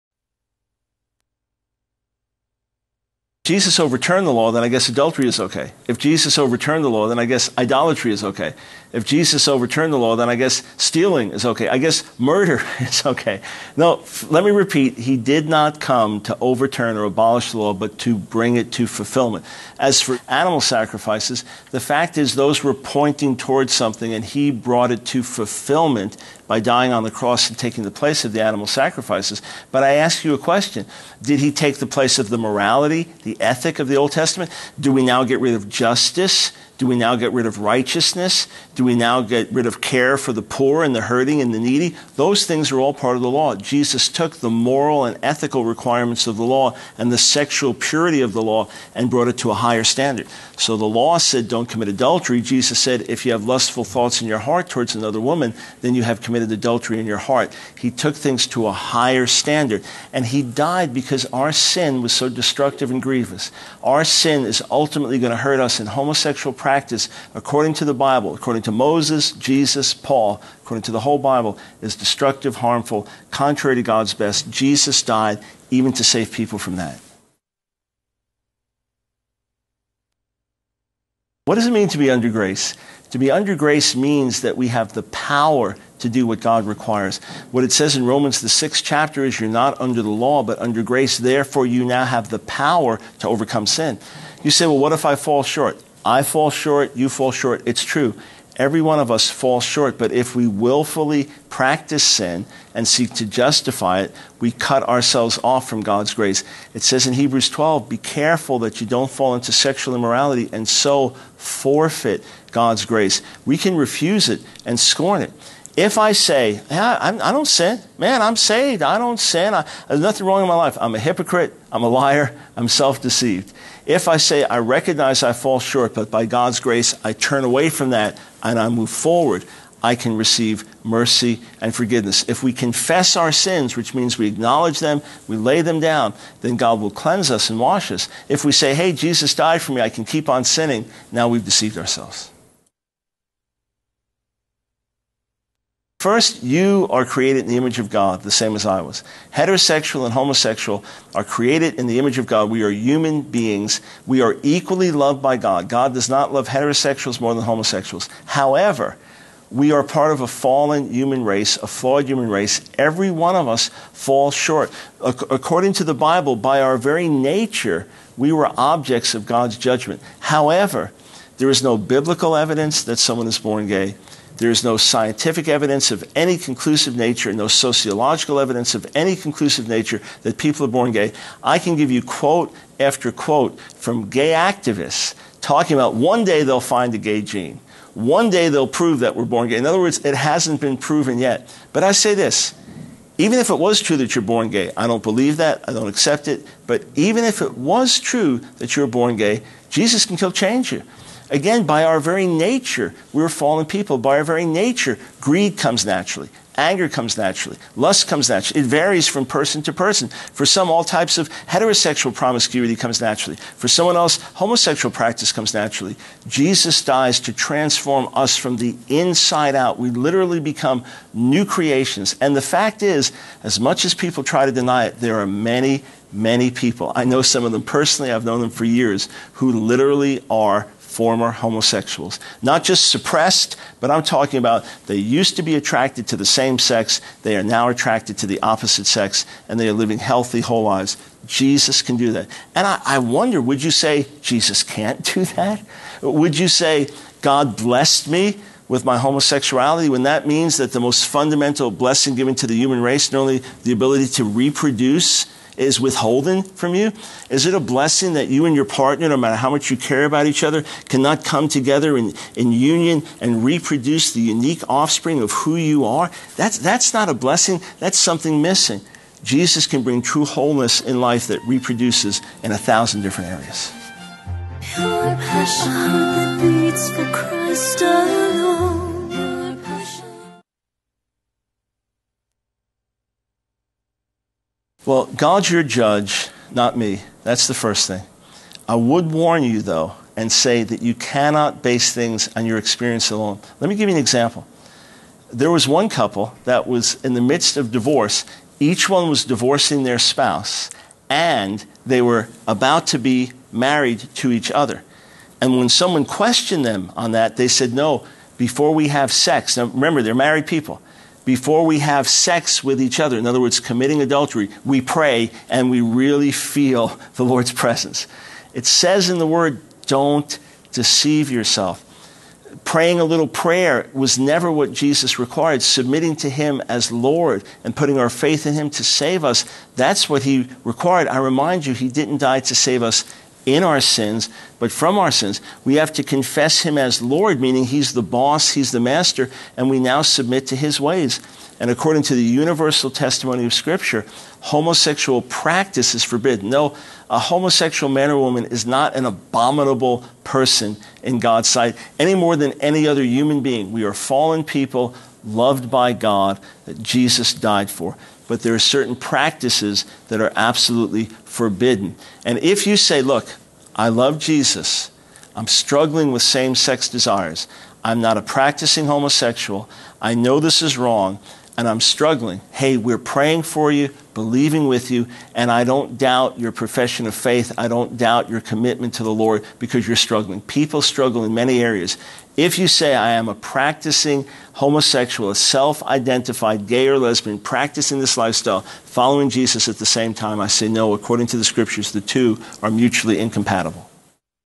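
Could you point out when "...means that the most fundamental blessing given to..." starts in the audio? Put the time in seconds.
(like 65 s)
250 s.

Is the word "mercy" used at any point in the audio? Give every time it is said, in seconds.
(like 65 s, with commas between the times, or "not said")
130 s.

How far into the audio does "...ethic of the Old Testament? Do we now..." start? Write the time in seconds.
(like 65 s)
33 s.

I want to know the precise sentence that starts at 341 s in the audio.
And according to the universal testimony of Scripture, homosexual practice is forbidden.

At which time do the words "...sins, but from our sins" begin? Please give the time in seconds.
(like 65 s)
333 s.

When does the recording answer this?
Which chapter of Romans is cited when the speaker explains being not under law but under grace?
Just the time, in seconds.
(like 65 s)
88 s.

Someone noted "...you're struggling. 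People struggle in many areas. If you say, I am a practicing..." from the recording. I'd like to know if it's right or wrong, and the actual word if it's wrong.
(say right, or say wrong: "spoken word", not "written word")
right.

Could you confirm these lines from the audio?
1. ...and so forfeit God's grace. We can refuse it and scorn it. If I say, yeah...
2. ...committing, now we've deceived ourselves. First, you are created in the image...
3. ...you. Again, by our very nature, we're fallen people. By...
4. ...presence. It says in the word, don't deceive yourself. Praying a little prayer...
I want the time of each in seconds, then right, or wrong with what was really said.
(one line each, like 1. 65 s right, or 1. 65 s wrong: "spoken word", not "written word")
1. 110 s right
2. 140 s wrong: "sinning", not "committing"
3. 200 s right
4. 317 s right.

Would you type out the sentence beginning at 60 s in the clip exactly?
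And he died because our sin was so destructive and grievous.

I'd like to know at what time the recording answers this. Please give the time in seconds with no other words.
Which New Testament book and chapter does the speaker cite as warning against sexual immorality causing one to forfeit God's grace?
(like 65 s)
107 s.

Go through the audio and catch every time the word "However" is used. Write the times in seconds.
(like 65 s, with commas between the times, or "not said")
158 s, 170 s.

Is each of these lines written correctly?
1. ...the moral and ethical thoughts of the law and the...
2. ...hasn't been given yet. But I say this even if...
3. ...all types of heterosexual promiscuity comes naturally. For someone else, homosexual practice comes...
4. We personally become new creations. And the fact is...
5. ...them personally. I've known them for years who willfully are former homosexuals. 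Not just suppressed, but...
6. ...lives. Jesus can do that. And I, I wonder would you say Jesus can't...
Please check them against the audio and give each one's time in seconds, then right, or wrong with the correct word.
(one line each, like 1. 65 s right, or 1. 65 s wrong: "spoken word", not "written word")
1. 44 s wrong: "requirements", not "thoughts"
2. 190 s wrong: "proven", not "given"
3. 210 s right
4. 219 s wrong: "literally", not "personally"
5. 227 s wrong: "literally", not "willfully"
6. 240 s right.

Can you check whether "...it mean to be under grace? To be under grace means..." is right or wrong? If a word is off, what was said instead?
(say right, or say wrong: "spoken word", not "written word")
right.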